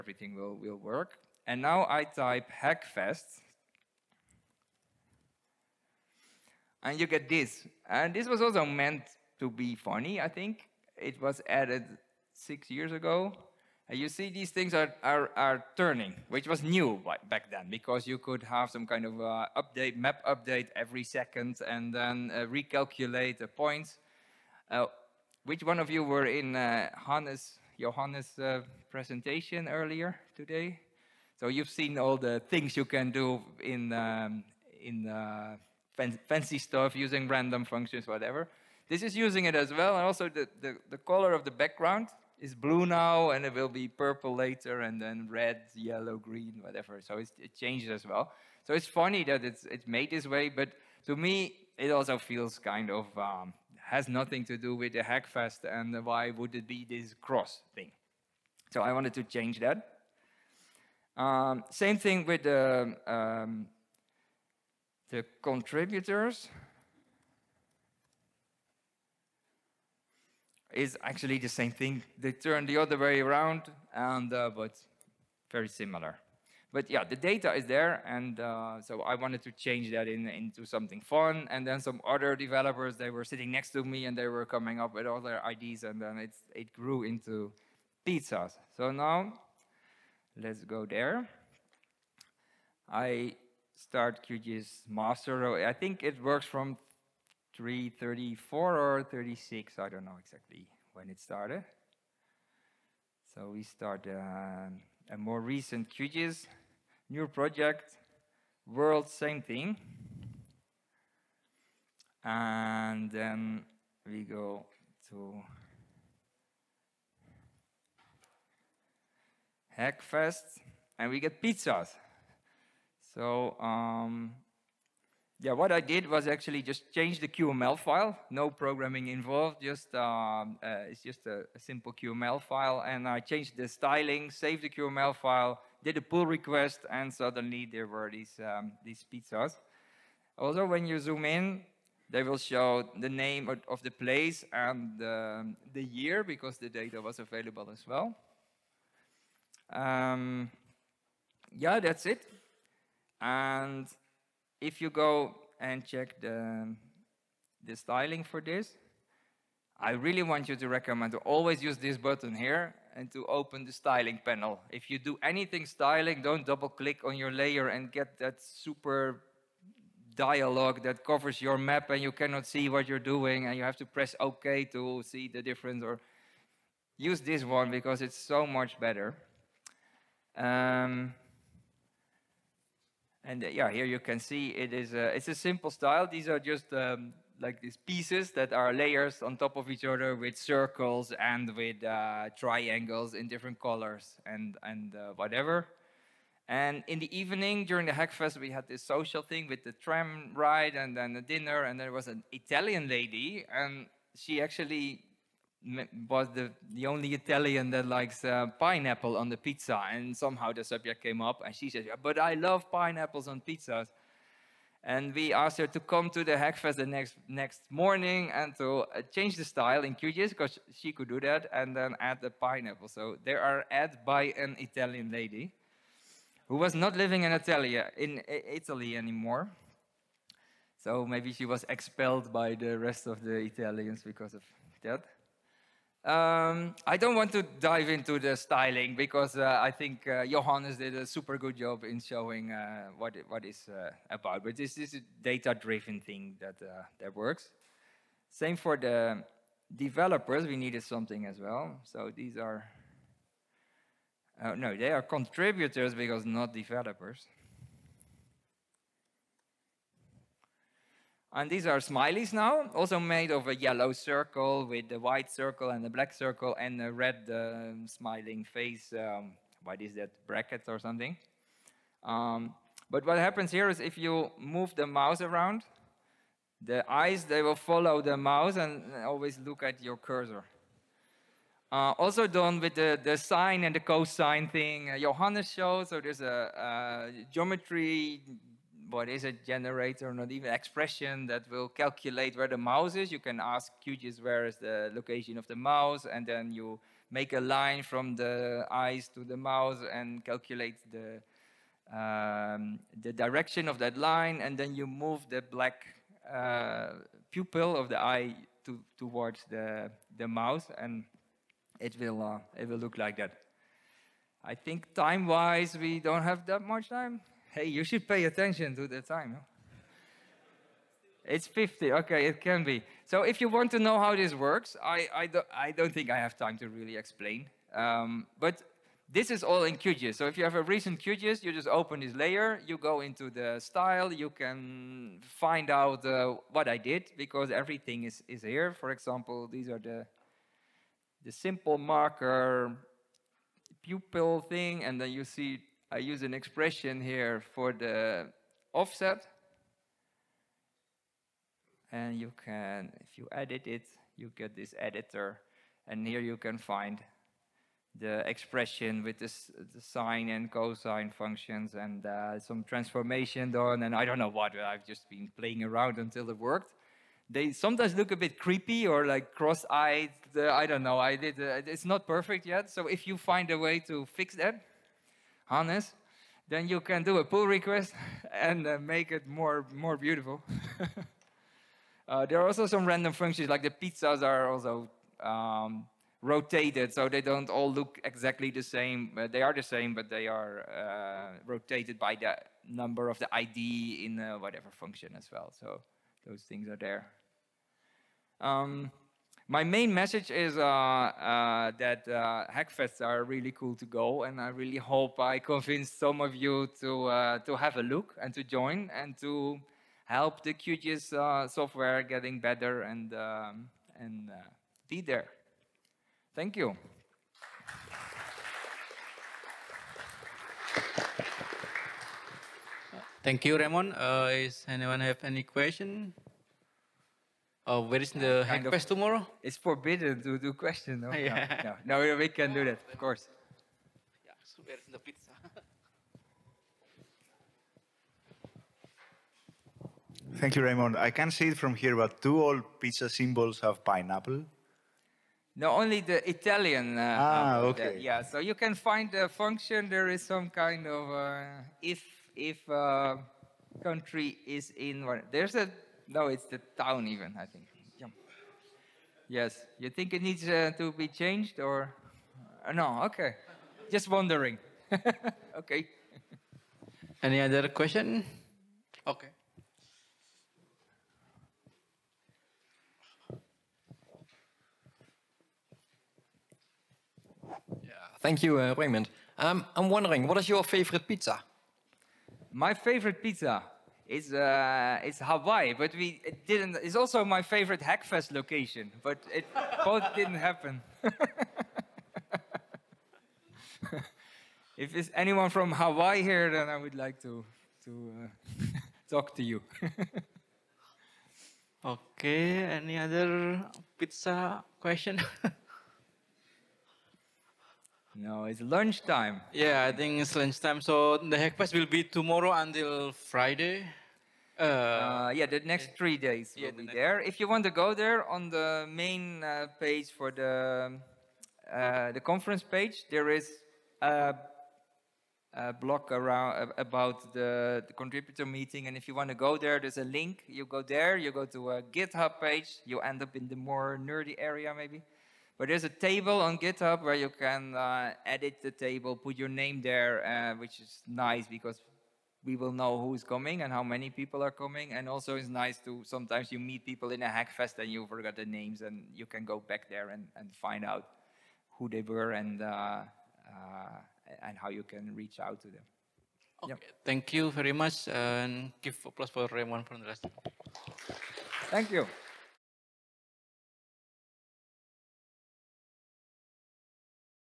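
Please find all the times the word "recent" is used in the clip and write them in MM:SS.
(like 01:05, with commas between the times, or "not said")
01:45, 05:30.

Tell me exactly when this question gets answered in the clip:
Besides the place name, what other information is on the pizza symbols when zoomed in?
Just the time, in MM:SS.
02:25.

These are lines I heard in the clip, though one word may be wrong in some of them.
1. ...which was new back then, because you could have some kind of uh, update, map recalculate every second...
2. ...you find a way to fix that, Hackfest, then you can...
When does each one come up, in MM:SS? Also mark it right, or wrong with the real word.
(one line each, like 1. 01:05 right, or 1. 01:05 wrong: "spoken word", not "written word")
1. 00:16 wrong: "update", not "recalculate"
2. 06:13 wrong: "Honest", not "Hackfest".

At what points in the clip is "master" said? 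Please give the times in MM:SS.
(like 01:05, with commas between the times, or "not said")
01:34.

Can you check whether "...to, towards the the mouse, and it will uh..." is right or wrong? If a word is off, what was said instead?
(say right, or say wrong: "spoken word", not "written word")
right.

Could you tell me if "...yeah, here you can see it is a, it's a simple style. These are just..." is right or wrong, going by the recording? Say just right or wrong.
right.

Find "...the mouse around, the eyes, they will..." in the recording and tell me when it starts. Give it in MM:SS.
04:34.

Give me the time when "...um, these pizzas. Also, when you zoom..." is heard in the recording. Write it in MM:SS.
02:18.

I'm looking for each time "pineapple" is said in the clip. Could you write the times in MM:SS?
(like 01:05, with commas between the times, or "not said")
03:28, 03:32, 03:42, 07:23.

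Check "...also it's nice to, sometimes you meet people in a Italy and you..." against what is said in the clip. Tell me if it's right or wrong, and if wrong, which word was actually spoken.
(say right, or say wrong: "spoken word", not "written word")
wrong: "Hackfest", not "Italy".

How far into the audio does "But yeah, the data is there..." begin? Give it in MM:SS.
01:16.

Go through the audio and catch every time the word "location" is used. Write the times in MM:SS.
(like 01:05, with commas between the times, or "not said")
04:54, 08:08.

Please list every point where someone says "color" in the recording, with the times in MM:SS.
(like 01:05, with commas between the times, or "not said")
00:40, 03:13.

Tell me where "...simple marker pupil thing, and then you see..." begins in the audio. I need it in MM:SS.
05:41.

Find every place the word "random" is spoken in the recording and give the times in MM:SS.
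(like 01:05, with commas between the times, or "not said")
00:37, 06:22.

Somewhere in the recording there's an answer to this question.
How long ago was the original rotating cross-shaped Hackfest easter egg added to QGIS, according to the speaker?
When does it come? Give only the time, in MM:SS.
00:12.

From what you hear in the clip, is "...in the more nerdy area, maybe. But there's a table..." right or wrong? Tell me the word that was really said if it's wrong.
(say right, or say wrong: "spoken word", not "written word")
right.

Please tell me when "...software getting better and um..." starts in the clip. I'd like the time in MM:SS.
06:51.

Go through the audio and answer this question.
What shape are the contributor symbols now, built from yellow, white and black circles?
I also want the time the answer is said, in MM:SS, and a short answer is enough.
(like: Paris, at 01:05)
Smileys, at 04:21.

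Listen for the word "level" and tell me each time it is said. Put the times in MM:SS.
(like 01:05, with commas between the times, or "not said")
not said.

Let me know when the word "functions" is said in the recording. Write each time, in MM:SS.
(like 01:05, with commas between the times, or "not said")
00:37, 06:01, 06:23, 06:34, 07:29.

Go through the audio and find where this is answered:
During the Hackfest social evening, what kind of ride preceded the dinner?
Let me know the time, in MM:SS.
03:19.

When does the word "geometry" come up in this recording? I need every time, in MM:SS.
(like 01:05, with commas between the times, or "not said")
04:47.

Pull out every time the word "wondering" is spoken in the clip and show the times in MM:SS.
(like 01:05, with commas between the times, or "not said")
07:44, 07:59.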